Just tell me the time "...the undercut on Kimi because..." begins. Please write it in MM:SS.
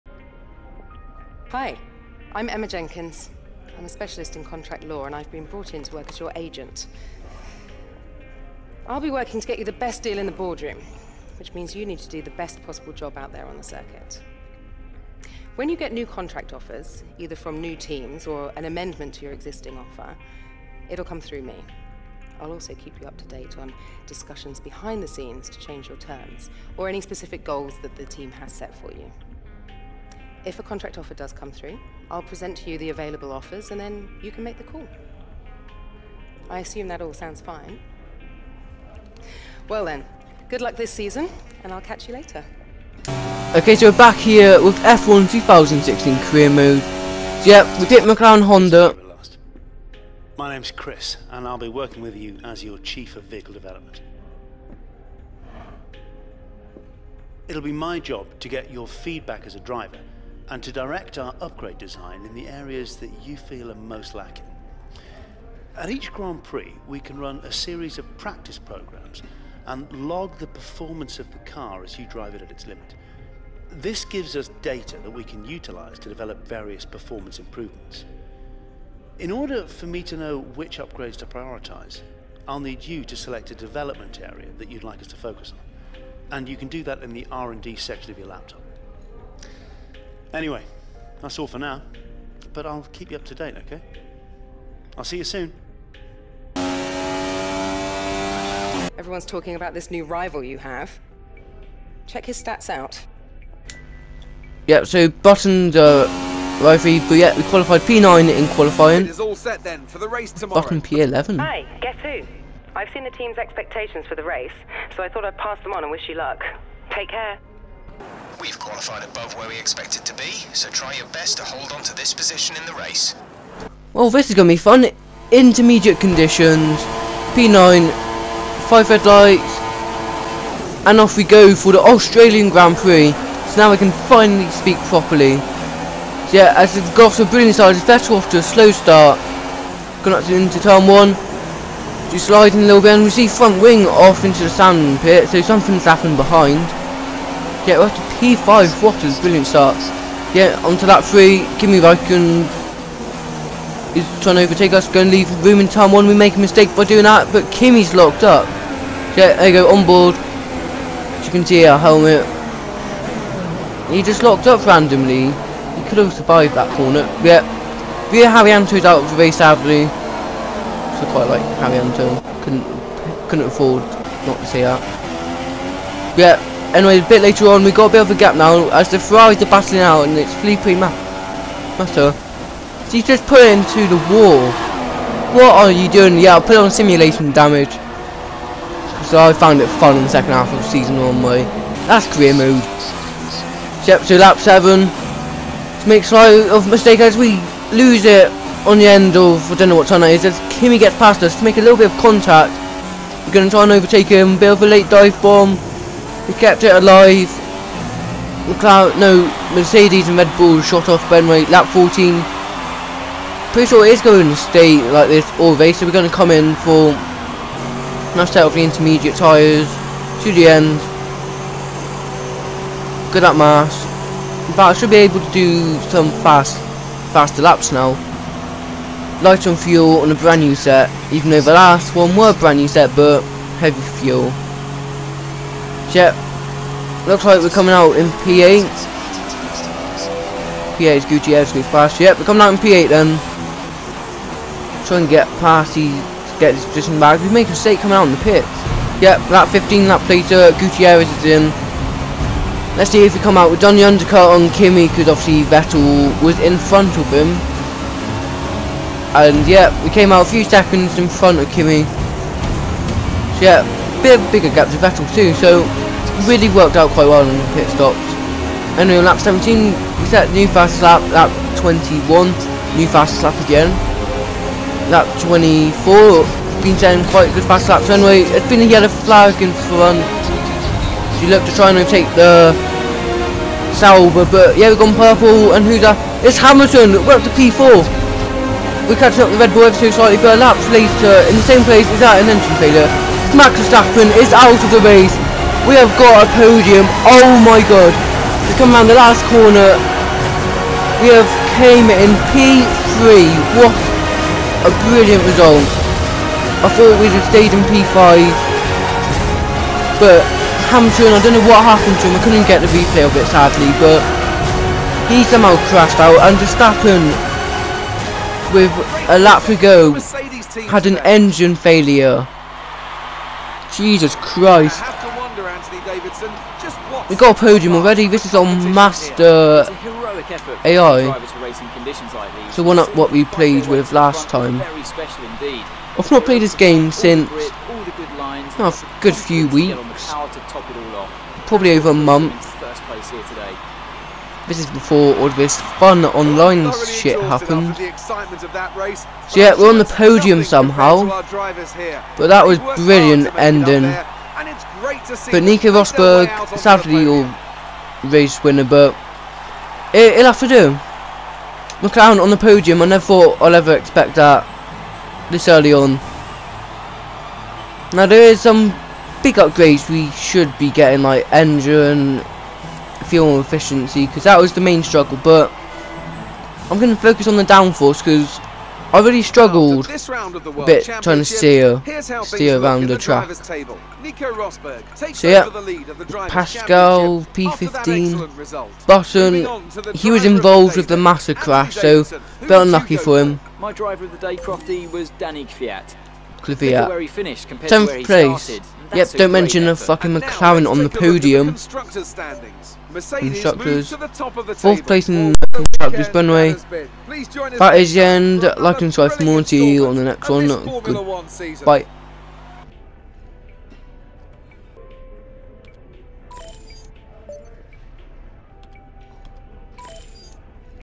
04:13.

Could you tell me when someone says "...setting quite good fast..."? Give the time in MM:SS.
04:36.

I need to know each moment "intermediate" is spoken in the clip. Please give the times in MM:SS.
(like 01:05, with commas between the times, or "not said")
02:05, 03:38.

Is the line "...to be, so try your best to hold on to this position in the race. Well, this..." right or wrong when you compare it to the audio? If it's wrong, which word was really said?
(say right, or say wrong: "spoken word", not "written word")
right.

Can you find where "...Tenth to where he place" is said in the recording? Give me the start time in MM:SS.
06:37.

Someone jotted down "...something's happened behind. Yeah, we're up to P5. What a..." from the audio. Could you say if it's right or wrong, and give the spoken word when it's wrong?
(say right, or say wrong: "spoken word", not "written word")
right.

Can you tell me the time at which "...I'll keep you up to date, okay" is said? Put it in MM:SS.
01:32.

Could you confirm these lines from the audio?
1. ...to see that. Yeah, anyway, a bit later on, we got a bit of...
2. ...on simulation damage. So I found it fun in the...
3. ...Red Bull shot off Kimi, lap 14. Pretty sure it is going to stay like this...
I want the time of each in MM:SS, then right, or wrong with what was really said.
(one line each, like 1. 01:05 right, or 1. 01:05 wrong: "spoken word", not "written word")
1. 02:54 right
2. 03:06 right
3. 03:30 wrong: "Benway", not "Kimi".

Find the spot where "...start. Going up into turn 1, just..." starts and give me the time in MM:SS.
02:18.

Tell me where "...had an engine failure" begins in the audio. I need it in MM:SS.
05:20.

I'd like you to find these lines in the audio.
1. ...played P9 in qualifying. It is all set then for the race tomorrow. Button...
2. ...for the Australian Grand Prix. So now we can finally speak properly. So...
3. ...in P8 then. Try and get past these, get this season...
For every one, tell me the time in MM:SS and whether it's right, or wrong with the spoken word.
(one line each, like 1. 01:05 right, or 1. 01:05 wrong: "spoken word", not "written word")
1. 01:47 wrong: "qualified", not "played"
2. 02:11 right
3. 04:02 wrong: "position", not "season".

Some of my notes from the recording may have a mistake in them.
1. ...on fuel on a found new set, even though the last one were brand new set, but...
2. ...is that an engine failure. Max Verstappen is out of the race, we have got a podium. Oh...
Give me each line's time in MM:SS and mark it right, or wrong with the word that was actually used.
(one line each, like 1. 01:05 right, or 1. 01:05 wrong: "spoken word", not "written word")
1. 03:49 wrong: "brand", not "found"
2. 04:51 right.